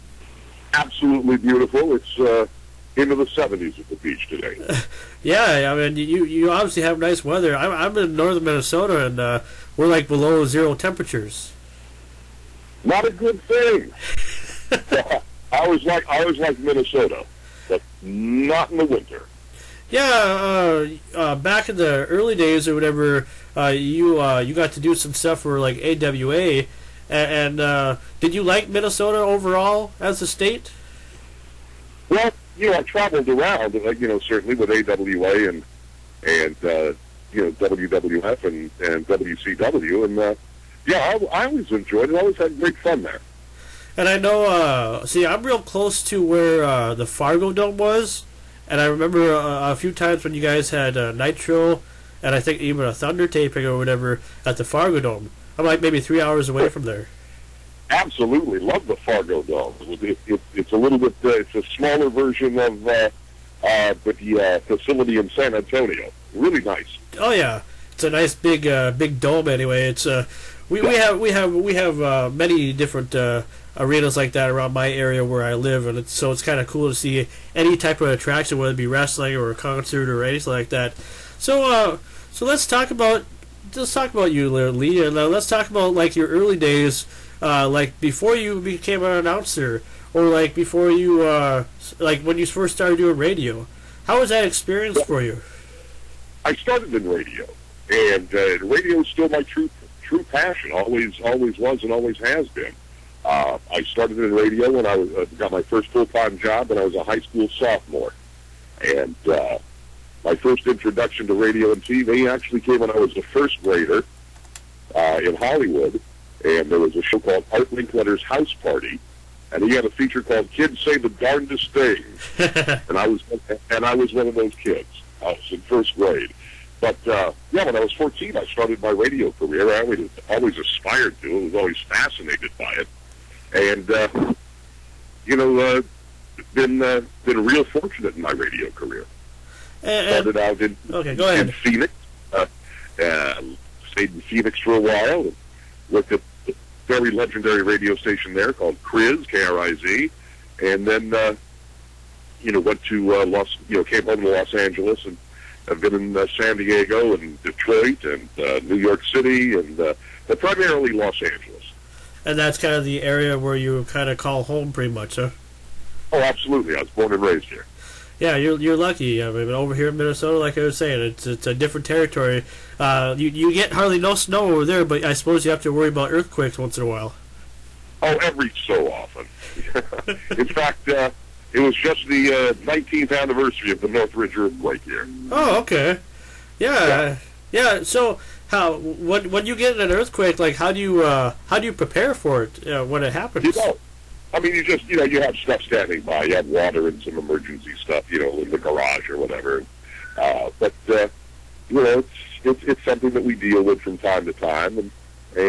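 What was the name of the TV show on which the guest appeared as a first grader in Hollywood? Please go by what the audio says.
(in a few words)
Art Linkletter's House Party.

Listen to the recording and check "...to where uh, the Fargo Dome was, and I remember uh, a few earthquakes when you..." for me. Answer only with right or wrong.
wrong.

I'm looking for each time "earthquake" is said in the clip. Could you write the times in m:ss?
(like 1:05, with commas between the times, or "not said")
2:56, 3:04, 3:09.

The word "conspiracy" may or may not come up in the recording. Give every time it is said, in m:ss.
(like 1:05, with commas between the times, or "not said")
not said.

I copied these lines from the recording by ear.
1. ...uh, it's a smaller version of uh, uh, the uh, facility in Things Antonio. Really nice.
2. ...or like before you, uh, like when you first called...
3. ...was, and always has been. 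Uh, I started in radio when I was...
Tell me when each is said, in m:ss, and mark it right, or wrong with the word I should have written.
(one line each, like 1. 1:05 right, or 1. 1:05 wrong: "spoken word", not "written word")
1. 1:01 wrong: "San", not "Things"
2. 1:30 wrong: "started", not "called"
3. 1:41 right.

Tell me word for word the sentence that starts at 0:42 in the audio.
I always had great fun there.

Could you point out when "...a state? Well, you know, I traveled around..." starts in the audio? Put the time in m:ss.
0:30.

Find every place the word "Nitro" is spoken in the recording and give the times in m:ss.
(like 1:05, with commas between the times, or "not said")
0:51.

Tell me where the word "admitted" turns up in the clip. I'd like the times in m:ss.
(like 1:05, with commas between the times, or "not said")
not said.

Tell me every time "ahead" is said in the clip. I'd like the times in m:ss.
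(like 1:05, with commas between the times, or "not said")
2:21.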